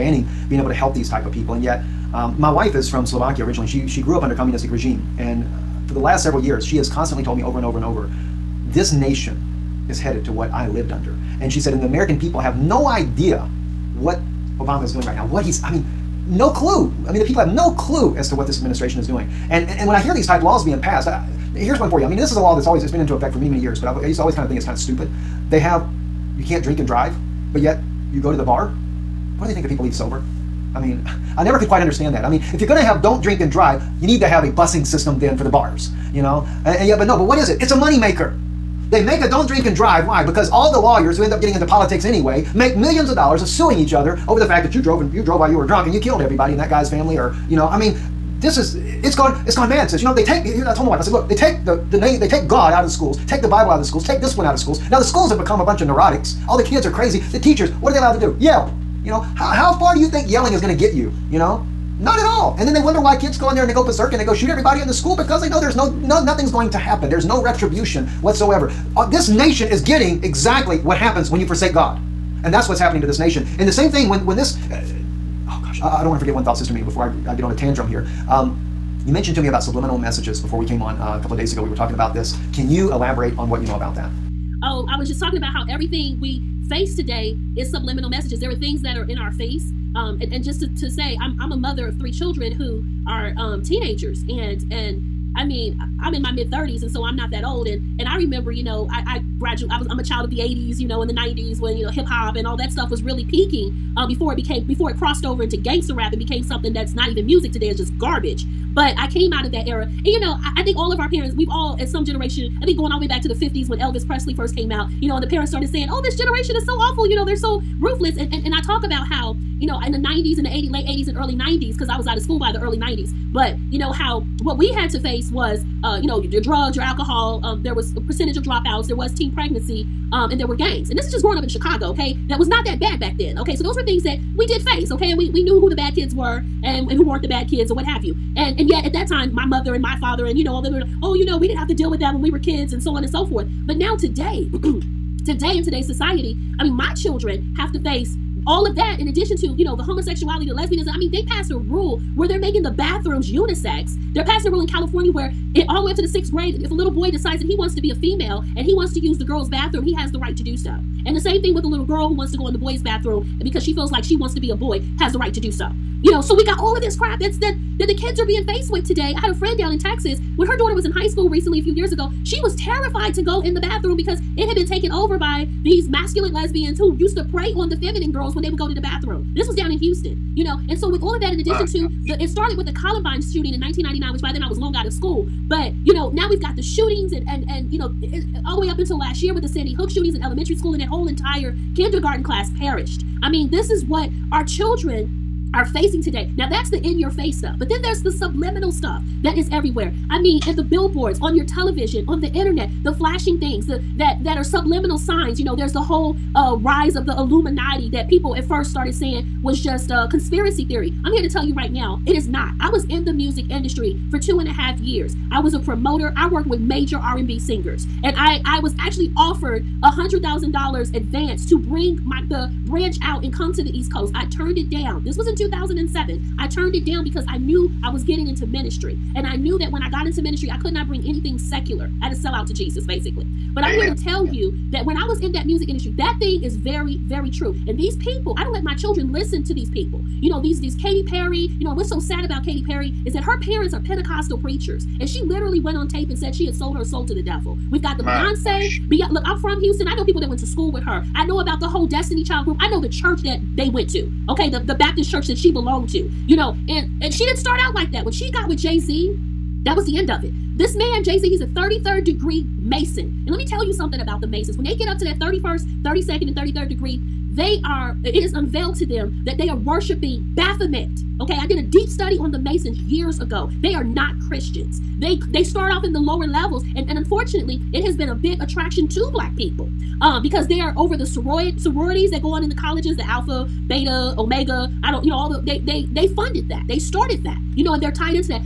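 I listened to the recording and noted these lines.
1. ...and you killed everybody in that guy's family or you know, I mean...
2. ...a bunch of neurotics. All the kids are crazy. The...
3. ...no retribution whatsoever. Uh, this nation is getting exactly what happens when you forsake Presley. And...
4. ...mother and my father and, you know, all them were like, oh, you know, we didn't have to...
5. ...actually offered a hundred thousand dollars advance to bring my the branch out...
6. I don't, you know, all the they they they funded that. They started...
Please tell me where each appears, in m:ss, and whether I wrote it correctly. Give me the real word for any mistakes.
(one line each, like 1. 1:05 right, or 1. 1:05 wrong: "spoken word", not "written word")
1. 0:45 right
2. 0:55 right
3. 1:07 wrong: "God", not "Presley"
4. 2:19 right
5. 3:38 right
6. 4:44 right.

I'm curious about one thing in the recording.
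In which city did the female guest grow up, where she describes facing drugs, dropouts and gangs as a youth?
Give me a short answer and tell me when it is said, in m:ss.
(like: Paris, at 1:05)
Chicago, at 2:11.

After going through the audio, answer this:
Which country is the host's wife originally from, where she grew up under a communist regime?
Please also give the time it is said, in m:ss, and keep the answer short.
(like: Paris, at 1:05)
Slovakia, at 0:03.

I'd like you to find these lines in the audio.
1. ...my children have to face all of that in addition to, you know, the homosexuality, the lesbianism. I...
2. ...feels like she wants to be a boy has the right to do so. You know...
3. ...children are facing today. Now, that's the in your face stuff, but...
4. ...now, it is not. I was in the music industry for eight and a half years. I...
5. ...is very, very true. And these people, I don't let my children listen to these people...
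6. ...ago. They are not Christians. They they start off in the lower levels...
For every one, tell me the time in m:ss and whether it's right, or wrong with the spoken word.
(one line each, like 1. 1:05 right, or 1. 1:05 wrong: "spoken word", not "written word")
1. 2:26 right
2. 2:43 right
3. 3:14 right
4. 3:31 wrong: "two", not "eight"
5. 3:56 right
6. 4:33 right.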